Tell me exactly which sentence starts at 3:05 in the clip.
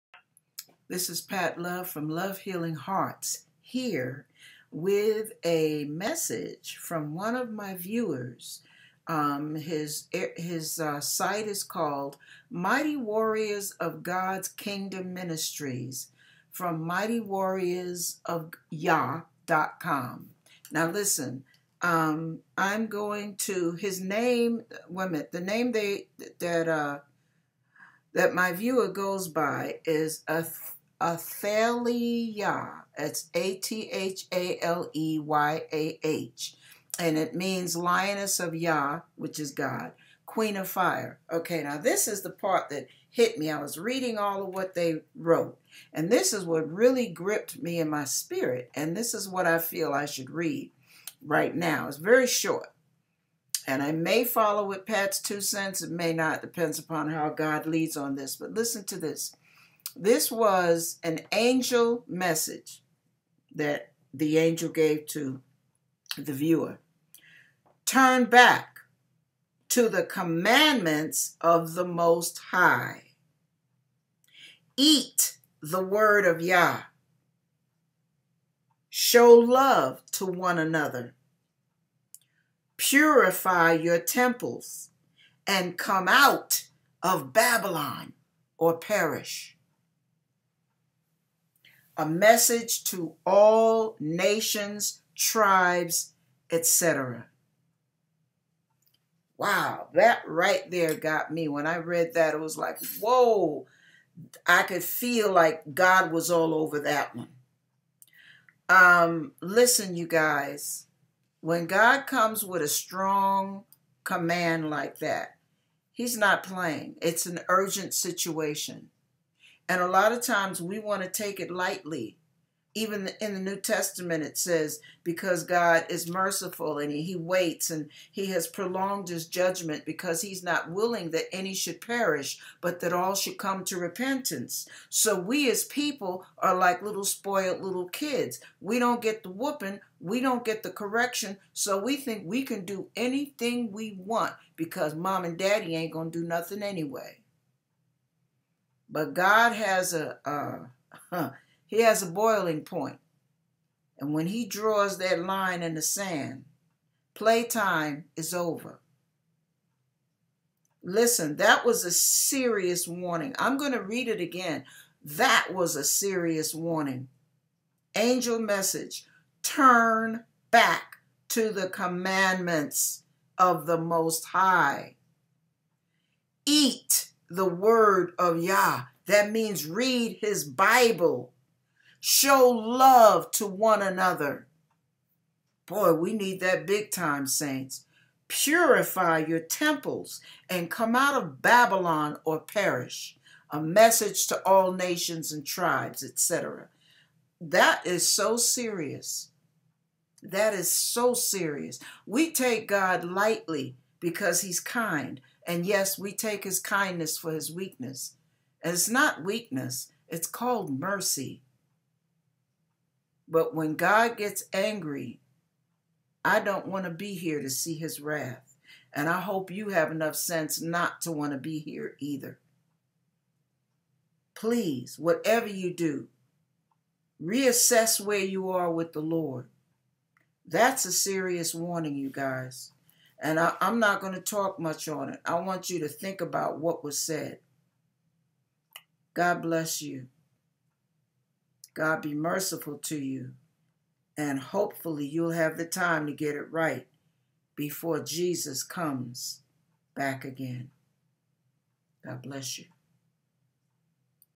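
Boy, we need that big time, saints.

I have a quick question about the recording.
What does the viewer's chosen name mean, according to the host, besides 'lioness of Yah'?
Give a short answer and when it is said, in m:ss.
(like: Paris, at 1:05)
Queen of fire, at 0:40.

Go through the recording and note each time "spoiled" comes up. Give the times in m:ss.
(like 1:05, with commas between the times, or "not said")
2:17.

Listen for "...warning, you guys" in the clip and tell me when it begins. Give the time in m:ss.
3:51.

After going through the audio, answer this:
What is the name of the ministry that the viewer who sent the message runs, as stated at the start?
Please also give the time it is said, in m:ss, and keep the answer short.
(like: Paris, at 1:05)
Mighty Warriors of God's Kingdom Ministries, at 0:12.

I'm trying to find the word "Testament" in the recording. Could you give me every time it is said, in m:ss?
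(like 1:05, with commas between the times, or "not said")
2:03.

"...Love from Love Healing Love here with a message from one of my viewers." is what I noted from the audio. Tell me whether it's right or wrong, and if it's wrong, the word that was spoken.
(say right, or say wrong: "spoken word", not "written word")
wrong: "Hearts", not "Love".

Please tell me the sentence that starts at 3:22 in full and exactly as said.
We take God lightly because he's kind.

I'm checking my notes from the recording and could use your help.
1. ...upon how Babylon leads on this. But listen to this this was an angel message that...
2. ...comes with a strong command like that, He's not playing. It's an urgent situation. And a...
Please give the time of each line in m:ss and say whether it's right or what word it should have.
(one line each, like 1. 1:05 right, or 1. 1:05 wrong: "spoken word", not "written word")
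1. 0:56 wrong: "God", not "Babylon"
2. 1:52 right.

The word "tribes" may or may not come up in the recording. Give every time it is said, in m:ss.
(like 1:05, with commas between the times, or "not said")
1:35, 3:15.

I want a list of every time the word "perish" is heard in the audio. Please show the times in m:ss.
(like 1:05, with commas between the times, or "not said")
1:28, 2:11, 3:12.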